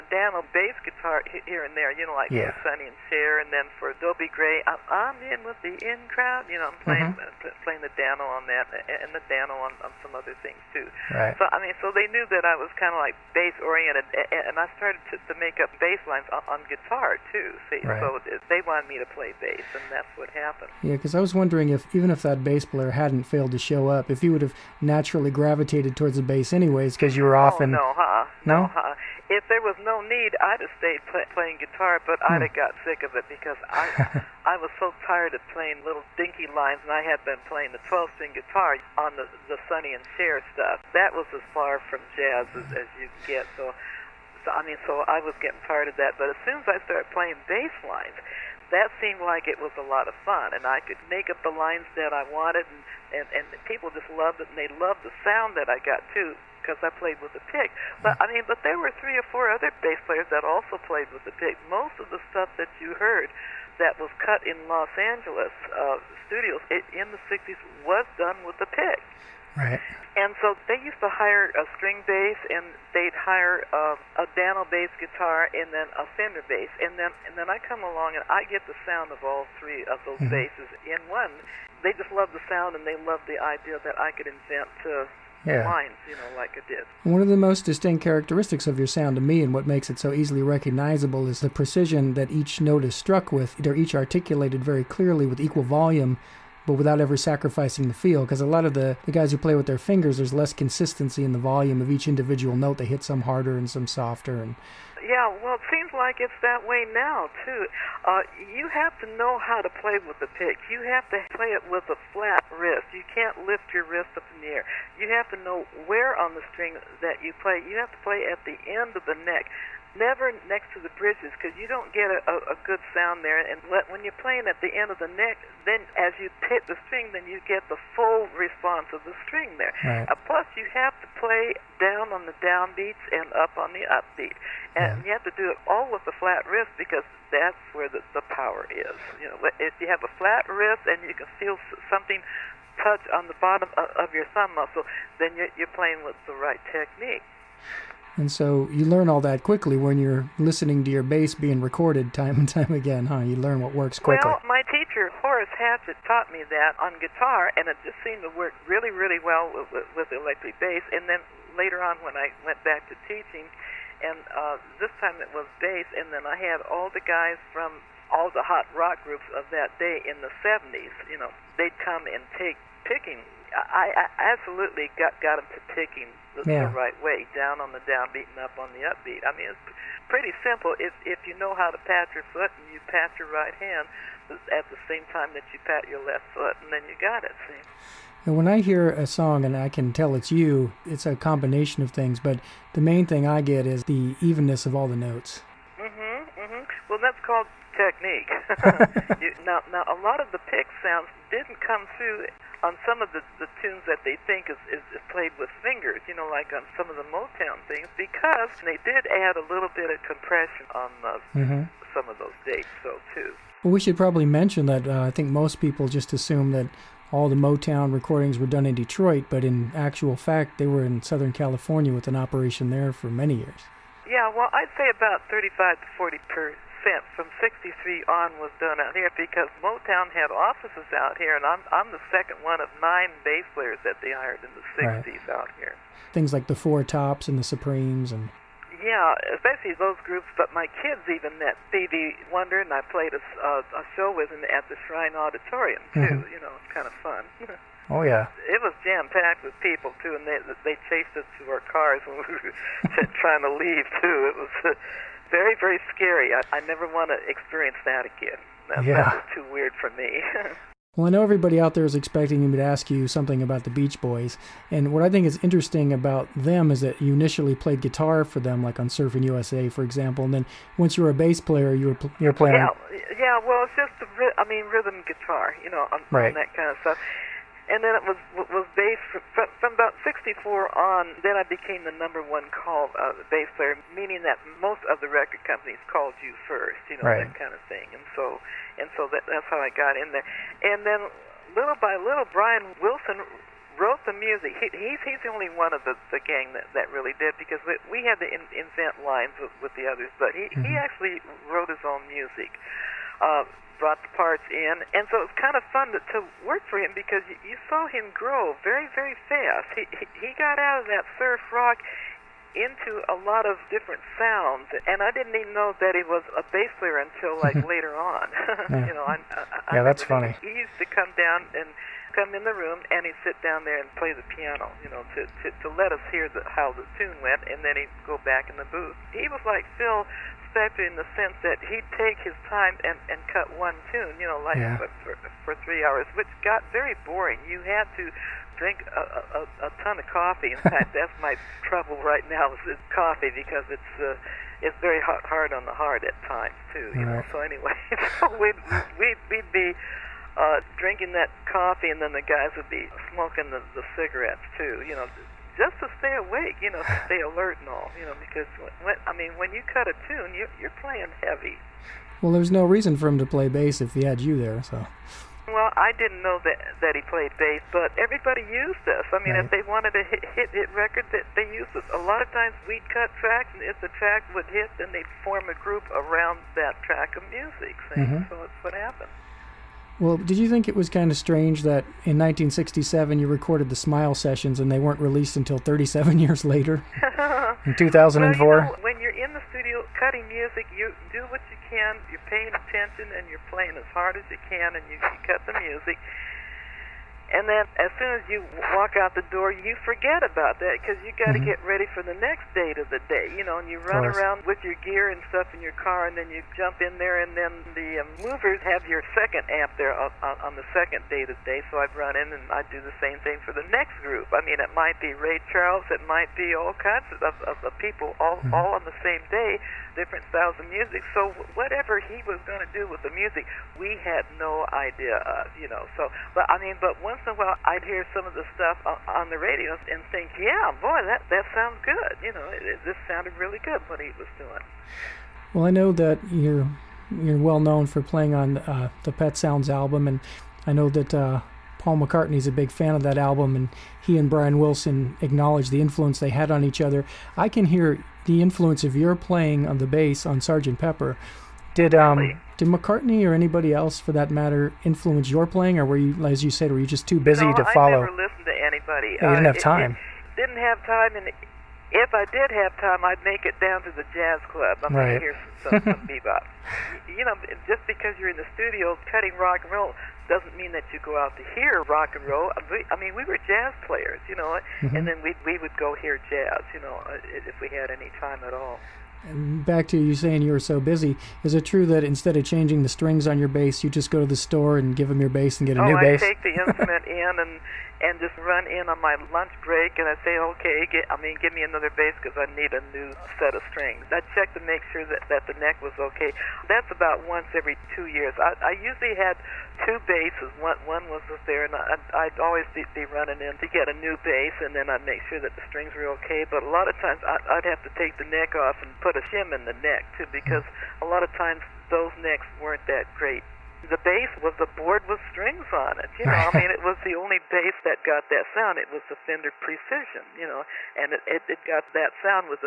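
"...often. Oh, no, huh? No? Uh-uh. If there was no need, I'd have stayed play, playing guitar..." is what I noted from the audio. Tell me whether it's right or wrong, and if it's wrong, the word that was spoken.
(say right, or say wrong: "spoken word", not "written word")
right.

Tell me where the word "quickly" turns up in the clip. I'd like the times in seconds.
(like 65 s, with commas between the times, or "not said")
149 s, 153 s.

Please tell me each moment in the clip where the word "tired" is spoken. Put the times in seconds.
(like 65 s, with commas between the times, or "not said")
35 s, 45 s.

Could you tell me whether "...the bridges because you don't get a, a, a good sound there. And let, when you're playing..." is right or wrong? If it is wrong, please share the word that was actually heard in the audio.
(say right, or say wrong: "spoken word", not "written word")
right.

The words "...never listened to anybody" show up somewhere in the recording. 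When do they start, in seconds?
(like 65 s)
458 s.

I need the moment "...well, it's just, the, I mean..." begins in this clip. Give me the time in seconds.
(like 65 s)
273 s.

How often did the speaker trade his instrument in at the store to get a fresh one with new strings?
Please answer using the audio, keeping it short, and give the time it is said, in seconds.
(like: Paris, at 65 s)
once every two years, at 497 s.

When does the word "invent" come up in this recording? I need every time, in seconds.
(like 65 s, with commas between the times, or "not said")
84 s, 298 s.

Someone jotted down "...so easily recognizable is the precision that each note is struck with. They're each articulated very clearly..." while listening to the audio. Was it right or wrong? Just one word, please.
right.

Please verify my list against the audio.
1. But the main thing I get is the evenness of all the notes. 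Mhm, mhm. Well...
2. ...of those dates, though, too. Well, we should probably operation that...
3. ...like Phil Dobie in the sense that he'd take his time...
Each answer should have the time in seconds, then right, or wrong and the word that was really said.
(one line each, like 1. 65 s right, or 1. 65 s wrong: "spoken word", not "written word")
1. 192 s right
2. 212 s wrong: "mention", not "operation"
3. 329 s wrong: "Spector", not "Dobie".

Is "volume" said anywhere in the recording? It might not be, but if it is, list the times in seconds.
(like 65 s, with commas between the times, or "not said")
95 s, 101 s.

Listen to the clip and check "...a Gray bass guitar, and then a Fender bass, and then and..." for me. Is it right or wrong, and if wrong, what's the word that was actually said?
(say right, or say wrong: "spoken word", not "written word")
wrong: "Dano", not "Gray".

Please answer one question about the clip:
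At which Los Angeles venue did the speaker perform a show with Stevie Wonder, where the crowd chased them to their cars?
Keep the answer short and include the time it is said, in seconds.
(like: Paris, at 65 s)
Shrine Auditorium, at 244 s.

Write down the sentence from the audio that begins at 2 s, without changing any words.
for Sonny and Cher, and then for Dobie Gray, I'm in with the in crowd.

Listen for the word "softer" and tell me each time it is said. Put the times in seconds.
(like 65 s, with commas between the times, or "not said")
103 s.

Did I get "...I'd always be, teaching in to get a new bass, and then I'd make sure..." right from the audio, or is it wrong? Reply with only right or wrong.
wrong.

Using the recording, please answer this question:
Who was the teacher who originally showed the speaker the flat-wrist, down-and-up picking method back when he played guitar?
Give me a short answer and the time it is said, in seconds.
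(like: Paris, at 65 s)
Horace Hatchett, at 155 s.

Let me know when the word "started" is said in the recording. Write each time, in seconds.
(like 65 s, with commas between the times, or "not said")
14 s, 46 s.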